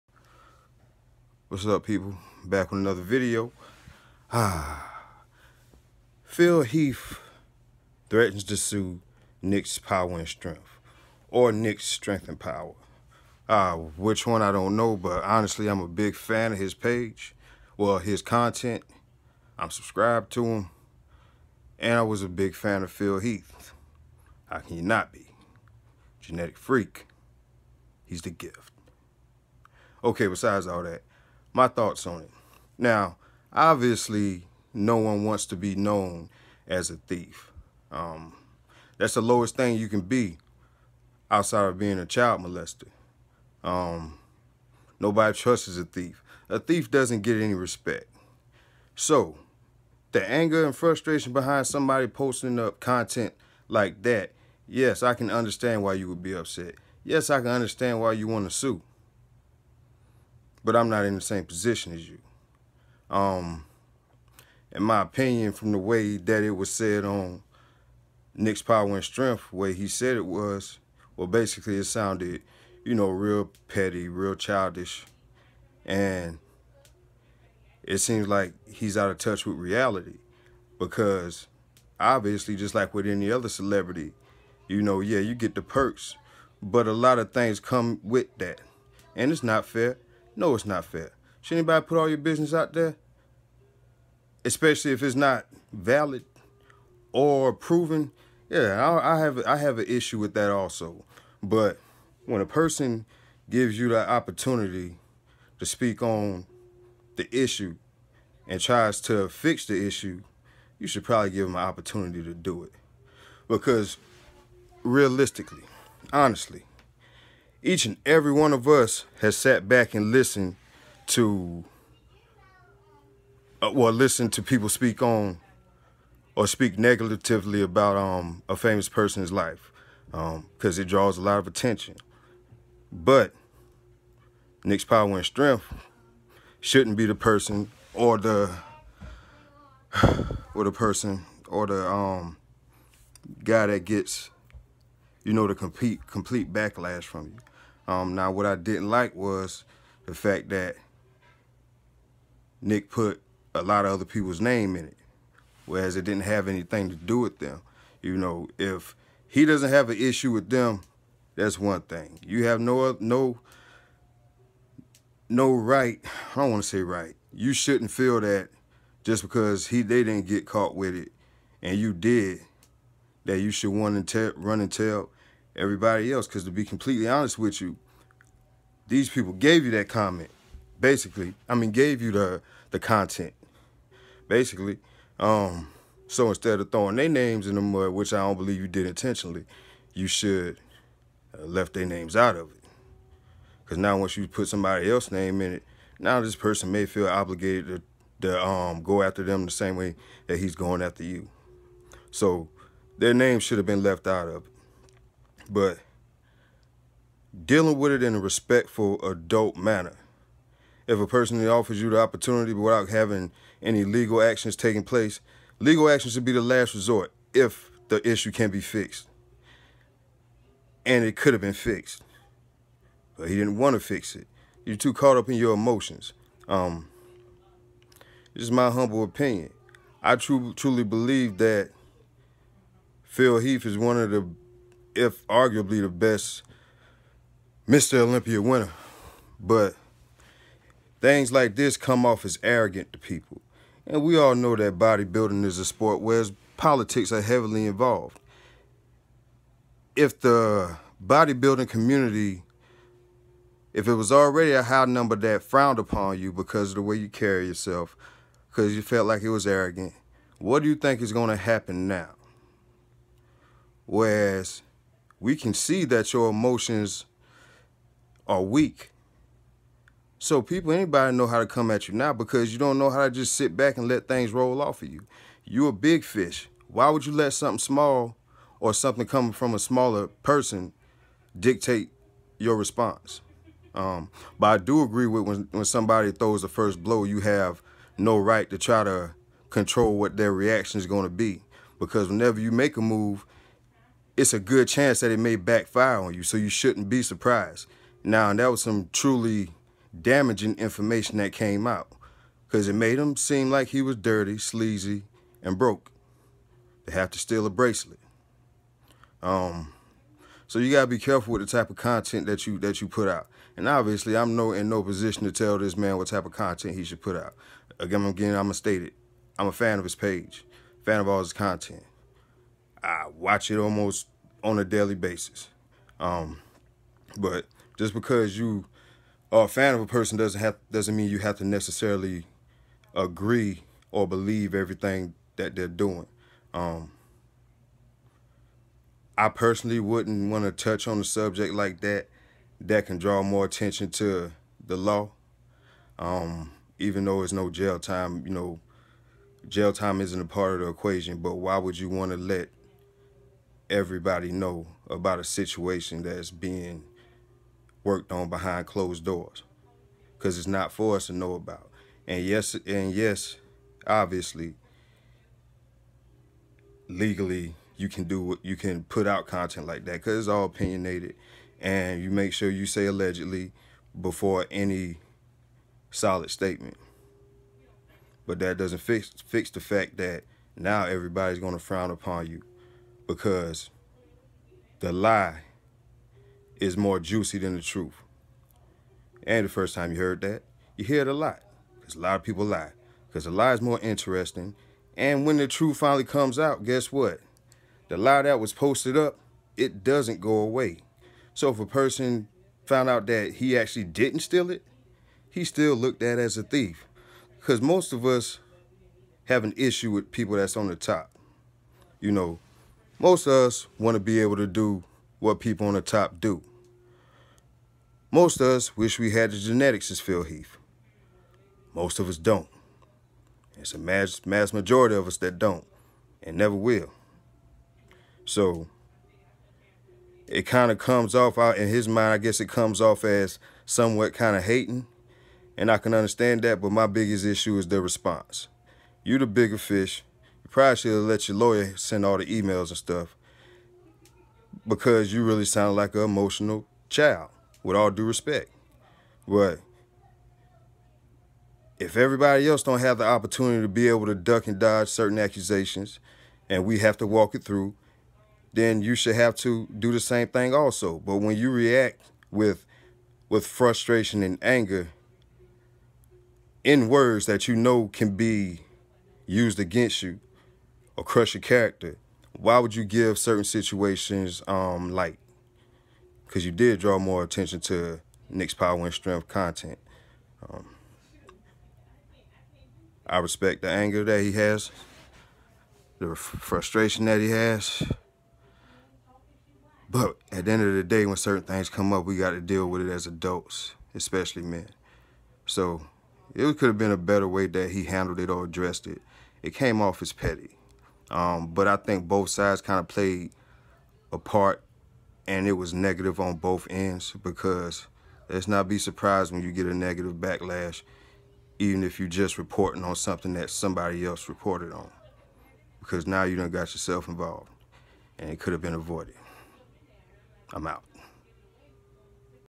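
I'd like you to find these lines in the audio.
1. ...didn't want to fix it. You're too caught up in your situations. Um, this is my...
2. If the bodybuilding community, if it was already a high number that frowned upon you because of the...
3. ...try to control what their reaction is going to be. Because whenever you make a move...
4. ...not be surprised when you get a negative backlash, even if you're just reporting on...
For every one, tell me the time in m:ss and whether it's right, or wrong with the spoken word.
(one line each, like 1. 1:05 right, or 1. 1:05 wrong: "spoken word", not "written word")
1. 3:43 wrong: "emotions", not "situations"
2. 4:09 right
3. 4:48 right
4. 8:28 right.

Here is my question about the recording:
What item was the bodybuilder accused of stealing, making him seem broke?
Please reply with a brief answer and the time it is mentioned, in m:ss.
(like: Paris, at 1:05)
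A bracelet, at 5:07.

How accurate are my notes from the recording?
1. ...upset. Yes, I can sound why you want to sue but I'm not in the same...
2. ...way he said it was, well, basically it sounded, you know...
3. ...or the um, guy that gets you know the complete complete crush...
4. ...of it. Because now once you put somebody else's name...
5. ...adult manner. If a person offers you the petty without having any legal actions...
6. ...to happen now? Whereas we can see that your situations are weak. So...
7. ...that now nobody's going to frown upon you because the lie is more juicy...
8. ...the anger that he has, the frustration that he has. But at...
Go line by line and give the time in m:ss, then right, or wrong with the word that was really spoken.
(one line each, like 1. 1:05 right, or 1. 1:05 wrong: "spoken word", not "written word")
1. 0:56 wrong: "understand", not "sound"
2. 1:09 right
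3. 2:21 wrong: "backlash", not "crush"
4. 3:12 right
5. 3:29 wrong: "opportunity", not "petty"
6. 4:21 wrong: "emotions", not "situations"
7. 6:19 wrong: "everybody", not "nobody"
8. 8:03 right.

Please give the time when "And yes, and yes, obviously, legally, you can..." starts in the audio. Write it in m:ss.
6:02.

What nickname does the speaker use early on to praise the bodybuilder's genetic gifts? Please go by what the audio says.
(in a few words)
The gift.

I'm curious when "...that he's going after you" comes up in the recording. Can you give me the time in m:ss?
3:20.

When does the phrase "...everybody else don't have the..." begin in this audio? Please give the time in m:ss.
7:31.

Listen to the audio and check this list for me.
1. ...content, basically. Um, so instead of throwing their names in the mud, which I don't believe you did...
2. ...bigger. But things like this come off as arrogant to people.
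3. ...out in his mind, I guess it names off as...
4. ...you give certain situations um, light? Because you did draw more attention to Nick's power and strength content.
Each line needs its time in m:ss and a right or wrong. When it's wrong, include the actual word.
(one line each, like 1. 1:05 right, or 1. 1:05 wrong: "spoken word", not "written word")
1. 3:02 right
2. 3:58 wrong: "winner", not "bigger"
3. 7:11 wrong: "comes", not "names"
4. 7:52 right.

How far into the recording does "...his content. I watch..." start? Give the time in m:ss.
5:21.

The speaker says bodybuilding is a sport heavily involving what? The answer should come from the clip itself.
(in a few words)
Politics.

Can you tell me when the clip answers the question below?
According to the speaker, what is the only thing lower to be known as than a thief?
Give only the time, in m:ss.
0:42.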